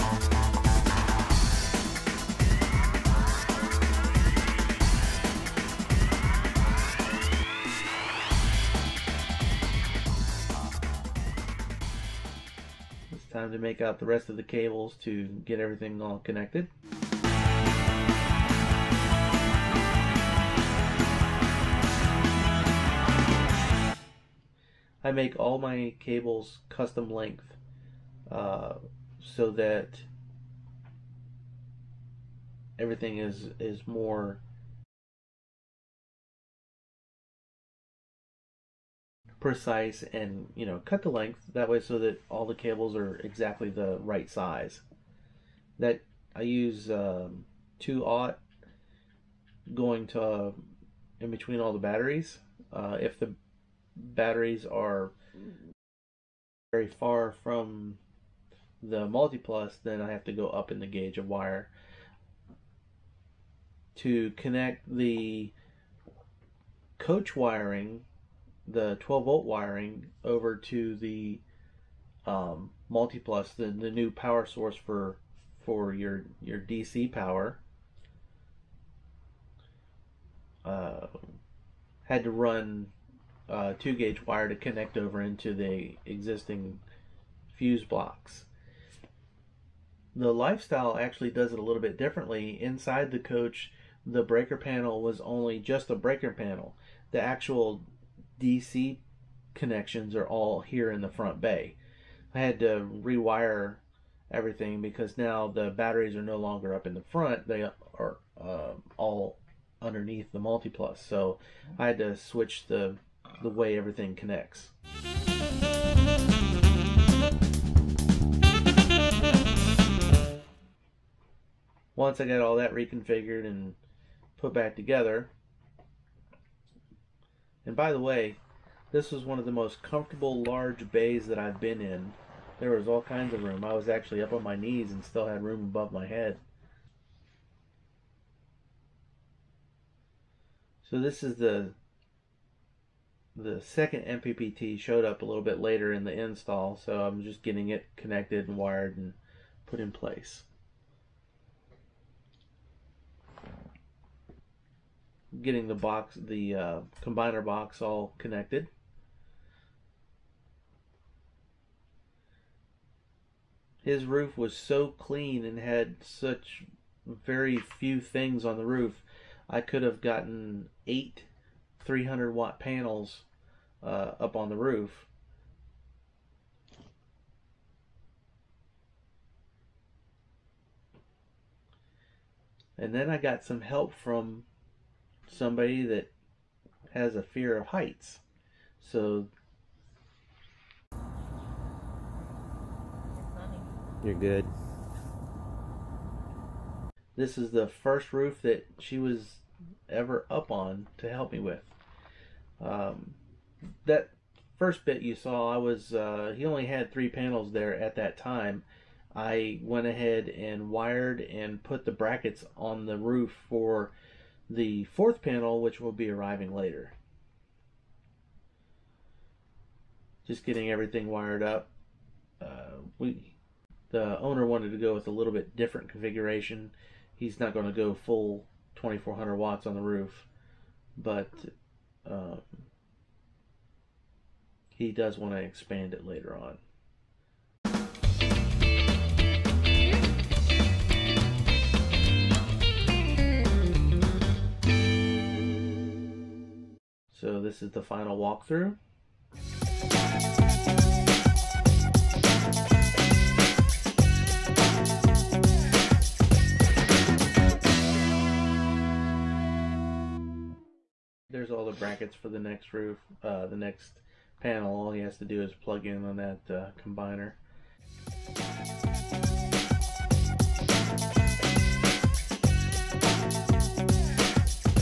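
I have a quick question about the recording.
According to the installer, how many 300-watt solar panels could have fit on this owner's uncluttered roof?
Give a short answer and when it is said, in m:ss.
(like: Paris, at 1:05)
8, at 2:50.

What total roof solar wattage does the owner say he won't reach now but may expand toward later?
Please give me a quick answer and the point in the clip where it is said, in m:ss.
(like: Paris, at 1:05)
2400 watts, at 3:48.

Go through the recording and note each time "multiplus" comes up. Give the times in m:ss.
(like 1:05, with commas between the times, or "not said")
0:59, 1:12, 1:50.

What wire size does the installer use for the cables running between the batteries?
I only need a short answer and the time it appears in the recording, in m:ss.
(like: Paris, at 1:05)
2/0, at 0:47.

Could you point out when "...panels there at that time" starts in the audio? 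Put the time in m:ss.
3:27.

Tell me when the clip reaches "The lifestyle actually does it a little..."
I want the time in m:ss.
1:30.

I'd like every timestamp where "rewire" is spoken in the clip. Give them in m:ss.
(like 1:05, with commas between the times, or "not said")
1:43.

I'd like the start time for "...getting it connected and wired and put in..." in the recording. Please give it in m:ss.
2:27.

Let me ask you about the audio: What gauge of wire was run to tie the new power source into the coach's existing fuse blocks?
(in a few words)
2 gauge.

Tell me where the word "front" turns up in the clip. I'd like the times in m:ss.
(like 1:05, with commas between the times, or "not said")
1:41, 1:47.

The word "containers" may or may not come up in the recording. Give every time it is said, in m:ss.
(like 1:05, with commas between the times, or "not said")
not said.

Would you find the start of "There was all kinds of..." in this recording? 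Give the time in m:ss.
2:12.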